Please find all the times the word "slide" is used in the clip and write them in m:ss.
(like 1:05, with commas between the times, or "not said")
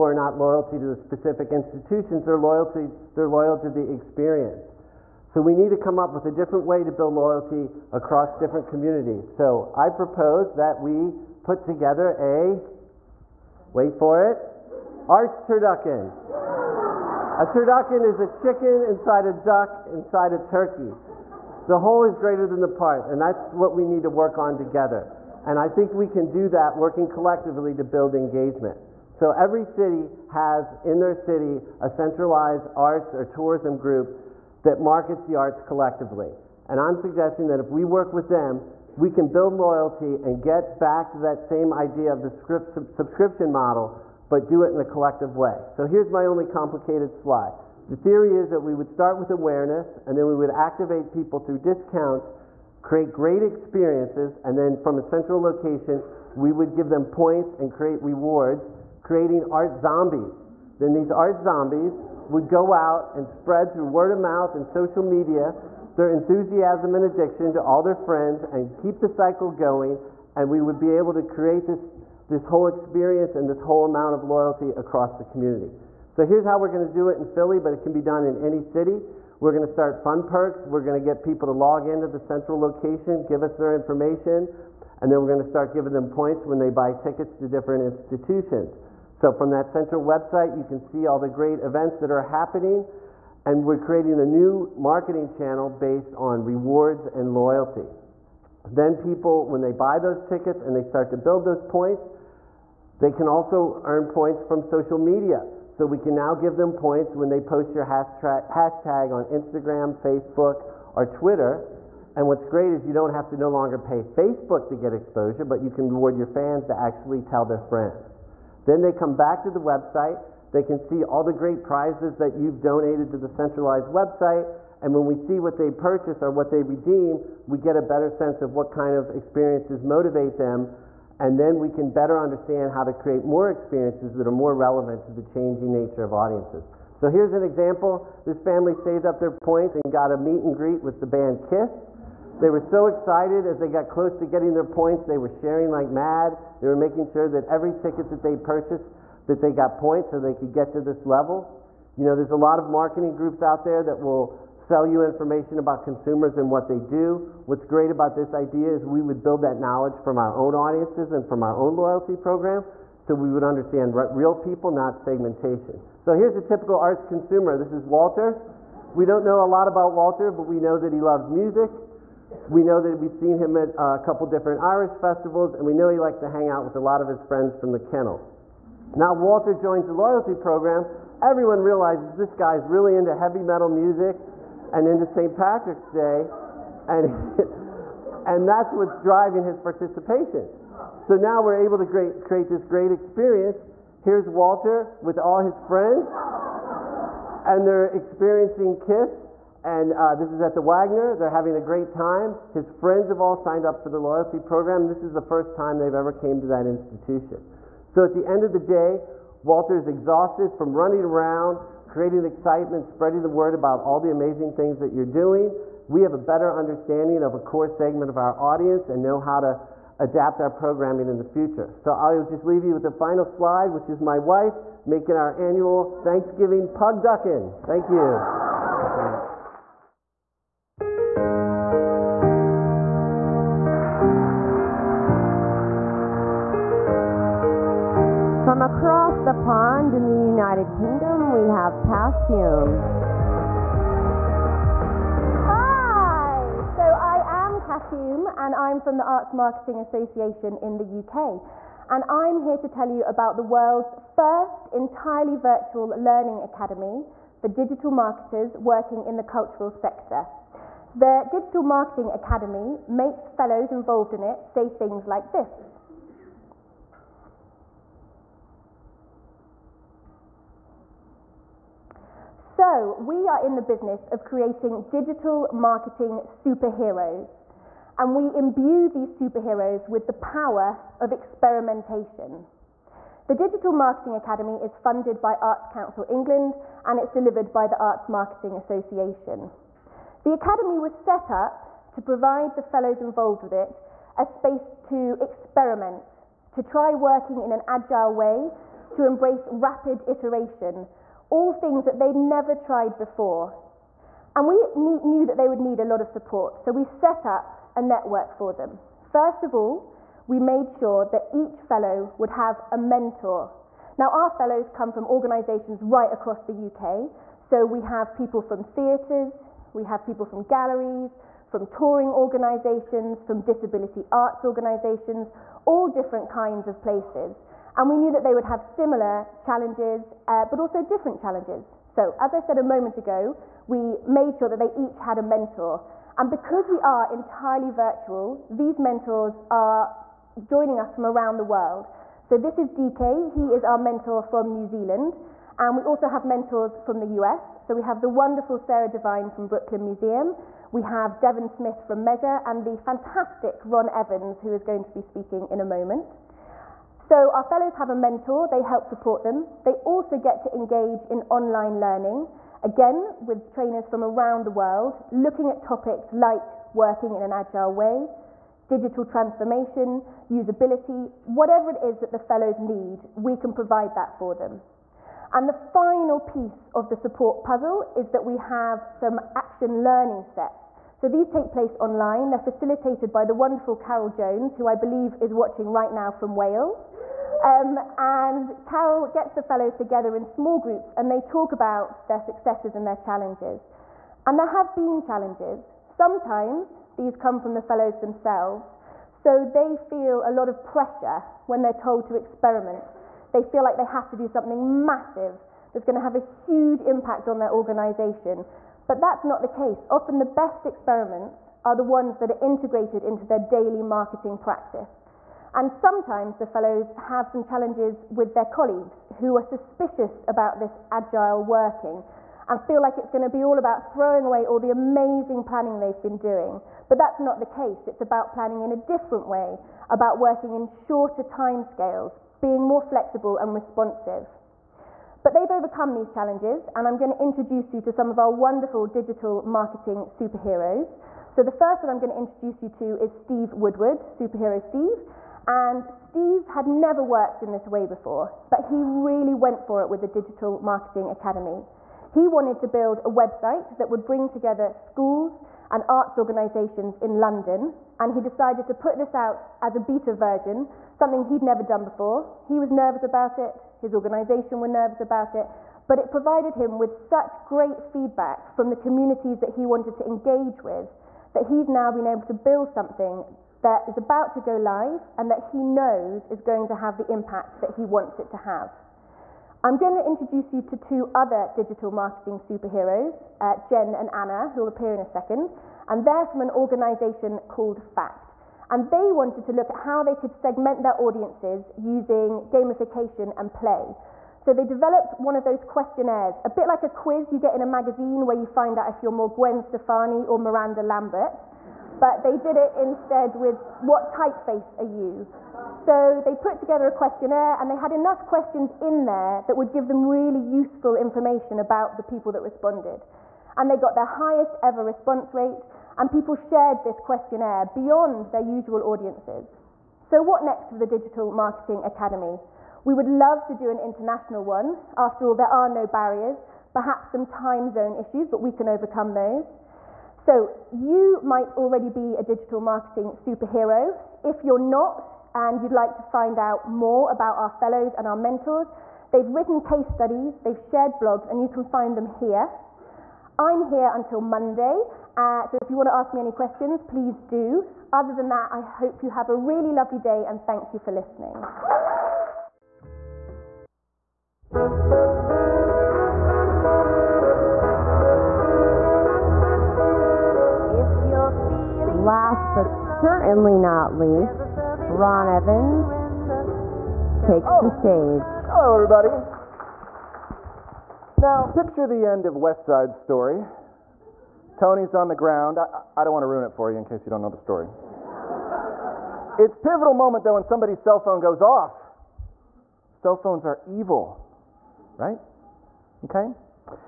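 0:47, 3:43.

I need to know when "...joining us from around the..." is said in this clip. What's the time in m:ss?
5:40.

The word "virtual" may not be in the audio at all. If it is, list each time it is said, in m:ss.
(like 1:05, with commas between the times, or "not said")
4:15, 5:37.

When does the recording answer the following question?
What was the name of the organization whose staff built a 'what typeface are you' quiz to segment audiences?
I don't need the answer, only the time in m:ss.
8:07.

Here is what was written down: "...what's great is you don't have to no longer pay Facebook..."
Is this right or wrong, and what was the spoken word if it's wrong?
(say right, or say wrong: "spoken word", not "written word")
right.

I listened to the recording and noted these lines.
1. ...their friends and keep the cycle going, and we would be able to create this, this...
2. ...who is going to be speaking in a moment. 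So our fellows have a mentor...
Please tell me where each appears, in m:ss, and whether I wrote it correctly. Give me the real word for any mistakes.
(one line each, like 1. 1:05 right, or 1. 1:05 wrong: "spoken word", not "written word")
1. 1:07 right
2. 5:54 right.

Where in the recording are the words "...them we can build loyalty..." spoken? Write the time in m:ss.
0:38.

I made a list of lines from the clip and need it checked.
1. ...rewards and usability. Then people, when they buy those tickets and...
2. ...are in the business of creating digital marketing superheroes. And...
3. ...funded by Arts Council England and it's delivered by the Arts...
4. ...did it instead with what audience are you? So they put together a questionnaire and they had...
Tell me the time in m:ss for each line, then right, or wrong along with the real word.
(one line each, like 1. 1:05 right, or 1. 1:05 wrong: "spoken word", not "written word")
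1. 1:36 wrong: "loyalty", not "usability"
2. 4:33 right
3. 4:44 right
4. 8:22 wrong: "typeface", not "audience".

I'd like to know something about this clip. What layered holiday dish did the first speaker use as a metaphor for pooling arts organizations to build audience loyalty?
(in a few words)
Arts turducken.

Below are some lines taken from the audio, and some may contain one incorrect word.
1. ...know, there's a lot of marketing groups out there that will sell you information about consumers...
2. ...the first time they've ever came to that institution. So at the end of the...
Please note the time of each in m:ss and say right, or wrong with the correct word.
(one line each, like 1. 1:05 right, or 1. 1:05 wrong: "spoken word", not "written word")
1. 2:32 right
2. 3:25 right.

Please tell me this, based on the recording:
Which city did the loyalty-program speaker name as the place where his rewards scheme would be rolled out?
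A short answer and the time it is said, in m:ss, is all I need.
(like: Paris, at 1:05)
Philly, at 1:17.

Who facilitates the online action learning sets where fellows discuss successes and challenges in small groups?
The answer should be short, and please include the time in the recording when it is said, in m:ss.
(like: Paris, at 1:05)
Carol Jones, at 6:23.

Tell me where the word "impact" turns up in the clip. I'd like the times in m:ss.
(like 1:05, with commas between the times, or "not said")
6:46, 7:57.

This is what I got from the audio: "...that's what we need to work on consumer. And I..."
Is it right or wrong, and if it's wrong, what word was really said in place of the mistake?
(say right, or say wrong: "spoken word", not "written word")
wrong: "together", not "consumer".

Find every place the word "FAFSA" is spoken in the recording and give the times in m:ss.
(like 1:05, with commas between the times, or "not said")
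not said.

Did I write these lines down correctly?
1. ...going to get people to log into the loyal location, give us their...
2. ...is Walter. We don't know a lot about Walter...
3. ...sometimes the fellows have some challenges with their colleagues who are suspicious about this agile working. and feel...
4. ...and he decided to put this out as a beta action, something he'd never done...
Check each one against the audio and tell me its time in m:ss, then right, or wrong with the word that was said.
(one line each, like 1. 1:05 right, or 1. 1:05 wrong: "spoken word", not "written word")
1. 1:20 wrong: "central", not "loyal"
2. 2:47 right
3. 6:55 right
4. 7:37 wrong: "version", not "action".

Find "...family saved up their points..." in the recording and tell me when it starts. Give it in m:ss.
2:18.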